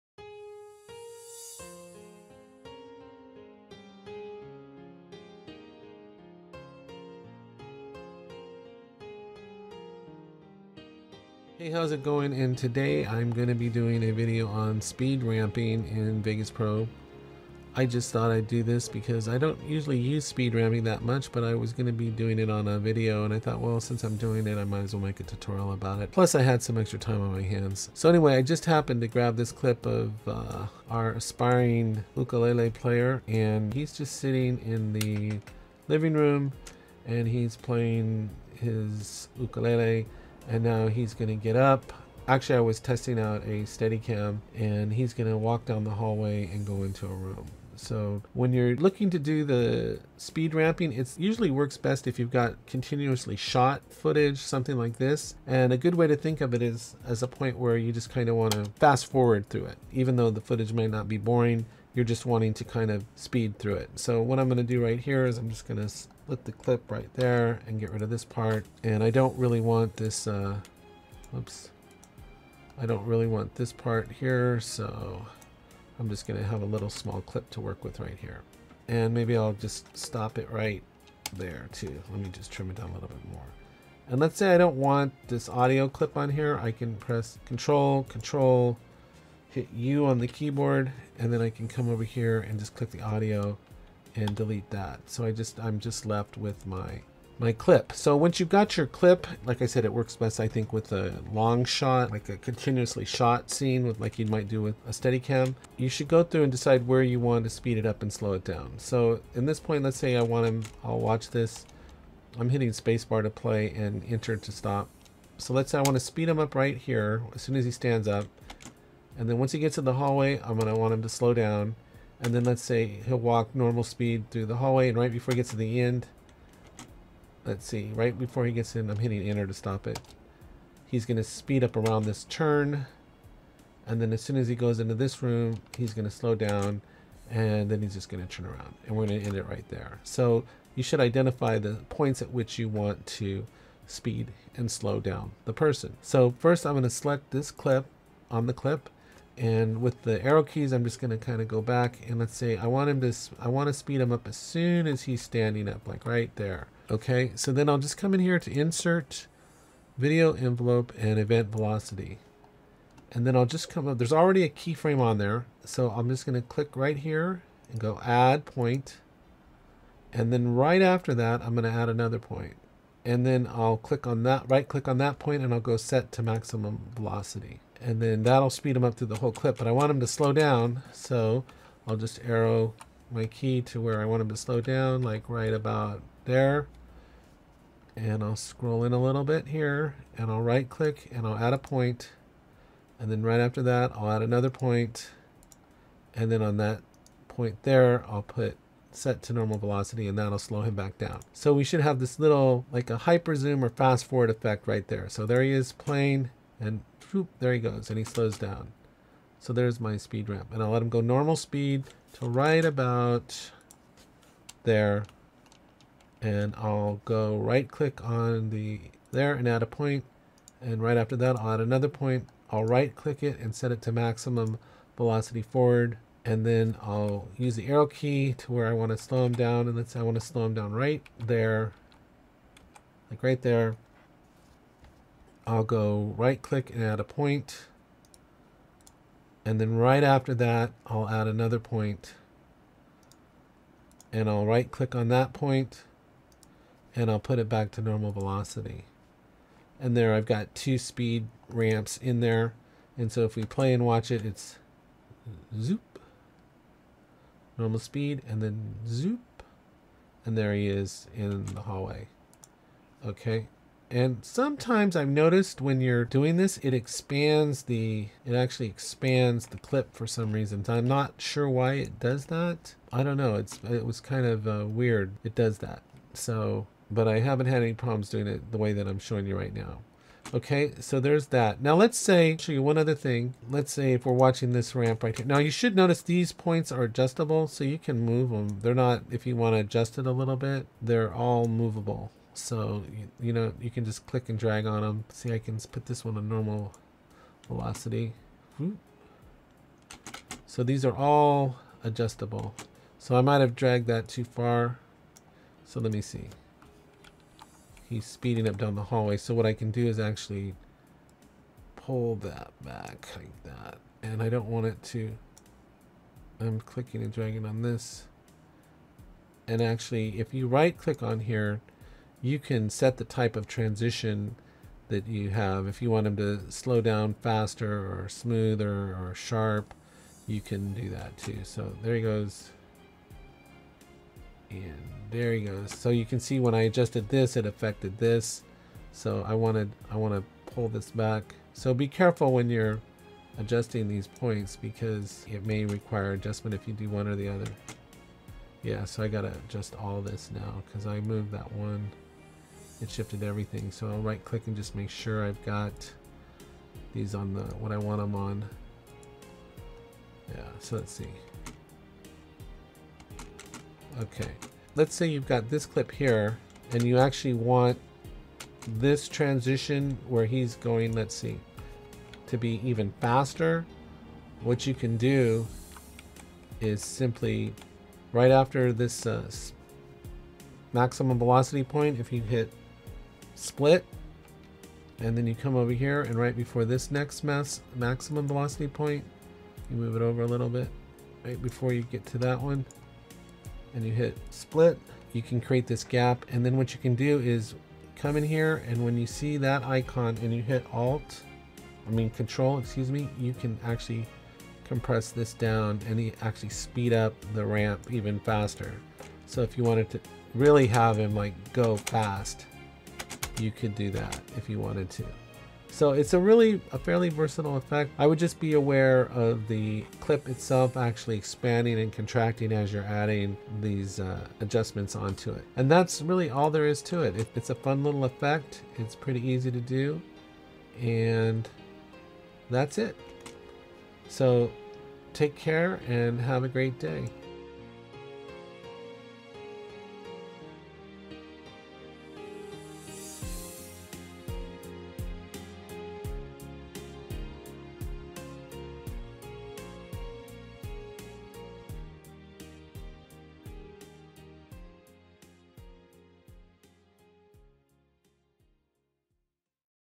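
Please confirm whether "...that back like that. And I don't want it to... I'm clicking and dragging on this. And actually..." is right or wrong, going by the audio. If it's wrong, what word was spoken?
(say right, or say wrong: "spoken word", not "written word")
right.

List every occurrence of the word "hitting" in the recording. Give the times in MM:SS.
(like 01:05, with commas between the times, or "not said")
01:52, 02:08.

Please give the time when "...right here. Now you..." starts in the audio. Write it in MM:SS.
04:45.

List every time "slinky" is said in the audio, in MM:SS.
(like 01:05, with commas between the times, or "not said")
not said.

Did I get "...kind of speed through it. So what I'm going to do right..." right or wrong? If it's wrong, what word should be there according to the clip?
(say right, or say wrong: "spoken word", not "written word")
right.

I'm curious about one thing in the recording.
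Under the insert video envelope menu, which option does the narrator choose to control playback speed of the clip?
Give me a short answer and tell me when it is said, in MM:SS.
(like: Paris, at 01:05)
event velocity, at 02:41.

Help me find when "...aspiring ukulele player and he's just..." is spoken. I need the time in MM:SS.
00:31.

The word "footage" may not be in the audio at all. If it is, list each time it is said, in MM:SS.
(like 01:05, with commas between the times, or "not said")
00:53, 01:00.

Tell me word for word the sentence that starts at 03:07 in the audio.
And I'll scroll in a little bit here and I'll right click and I'll add a point.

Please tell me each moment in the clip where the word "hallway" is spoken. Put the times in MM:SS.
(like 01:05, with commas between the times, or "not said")
00:45, 01:59, 02:04, 04:21, 05:08.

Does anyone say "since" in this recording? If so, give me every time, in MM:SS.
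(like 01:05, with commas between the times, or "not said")
00:23.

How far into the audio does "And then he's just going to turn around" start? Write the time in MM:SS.
02:17.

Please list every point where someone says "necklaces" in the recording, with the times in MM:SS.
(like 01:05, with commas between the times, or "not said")
not said.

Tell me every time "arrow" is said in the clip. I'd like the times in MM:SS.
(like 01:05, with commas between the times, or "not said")
02:30, 03:02, 03:47.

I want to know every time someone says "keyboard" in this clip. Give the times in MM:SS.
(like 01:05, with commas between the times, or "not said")
01:30.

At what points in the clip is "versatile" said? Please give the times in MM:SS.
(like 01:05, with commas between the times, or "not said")
06:57.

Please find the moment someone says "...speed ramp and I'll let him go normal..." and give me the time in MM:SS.
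03:29.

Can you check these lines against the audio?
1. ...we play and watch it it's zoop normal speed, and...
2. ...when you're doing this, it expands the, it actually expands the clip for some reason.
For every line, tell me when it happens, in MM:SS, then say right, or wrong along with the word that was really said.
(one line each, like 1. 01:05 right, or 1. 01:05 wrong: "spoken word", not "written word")
1. 04:13 right
2. 04:25 right.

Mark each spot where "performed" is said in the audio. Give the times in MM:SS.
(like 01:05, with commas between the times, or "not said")
not said.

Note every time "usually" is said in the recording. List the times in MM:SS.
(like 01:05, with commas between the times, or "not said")
00:19, 00:51.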